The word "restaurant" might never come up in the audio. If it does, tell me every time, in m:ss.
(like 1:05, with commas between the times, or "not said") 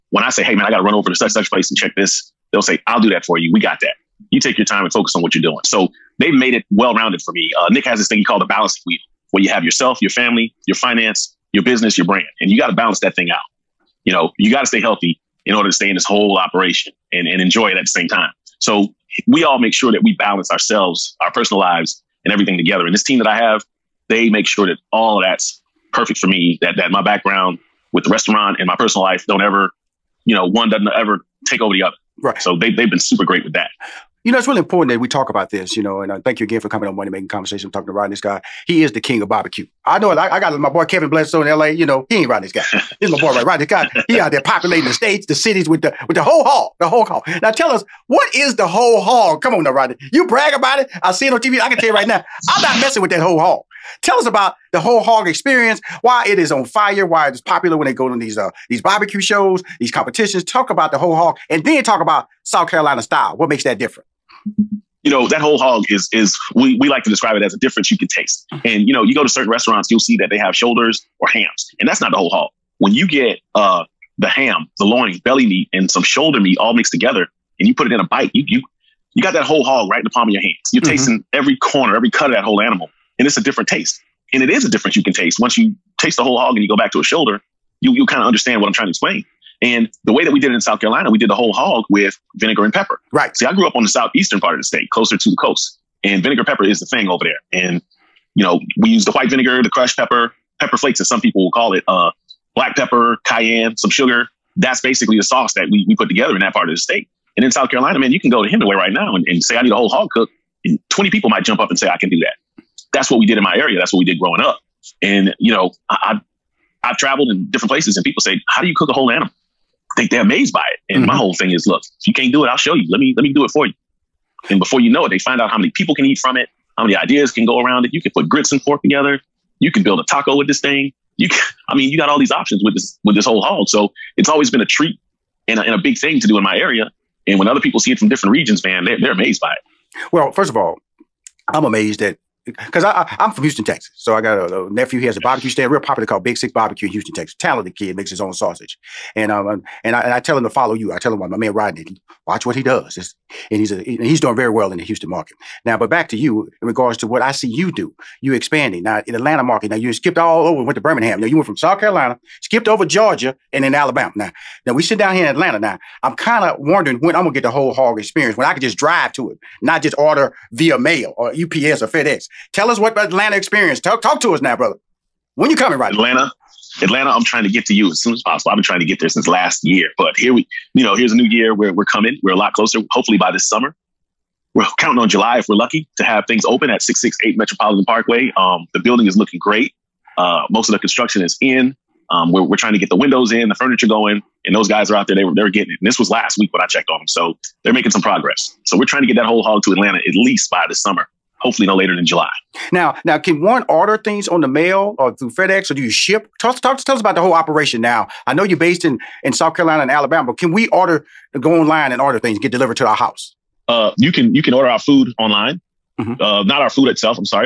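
0:28, 1:09.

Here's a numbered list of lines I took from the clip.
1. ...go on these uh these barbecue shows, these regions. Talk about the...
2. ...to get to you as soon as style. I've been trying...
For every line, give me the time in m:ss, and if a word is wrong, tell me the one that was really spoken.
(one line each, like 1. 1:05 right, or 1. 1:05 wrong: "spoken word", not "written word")
1. 0:57 wrong: "competitions", not "regions"
2. 2:57 wrong: "possible", not "style".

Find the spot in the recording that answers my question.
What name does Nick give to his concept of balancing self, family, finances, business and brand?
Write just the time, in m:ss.
0:08.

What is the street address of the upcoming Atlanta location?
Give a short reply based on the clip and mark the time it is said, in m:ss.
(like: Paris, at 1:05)
668 Metropolitan Parkway, at 3:06.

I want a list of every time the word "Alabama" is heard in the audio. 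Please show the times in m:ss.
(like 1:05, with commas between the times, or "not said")
2:43, 3:29.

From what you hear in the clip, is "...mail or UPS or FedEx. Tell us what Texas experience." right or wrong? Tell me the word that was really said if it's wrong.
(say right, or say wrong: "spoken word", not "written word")
wrong: "Atlanta", not "Texas".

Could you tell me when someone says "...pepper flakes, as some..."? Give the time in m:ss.
1:40.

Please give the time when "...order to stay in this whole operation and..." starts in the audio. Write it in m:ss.
0:15.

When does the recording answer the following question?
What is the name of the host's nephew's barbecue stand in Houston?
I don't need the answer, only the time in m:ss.
2:26.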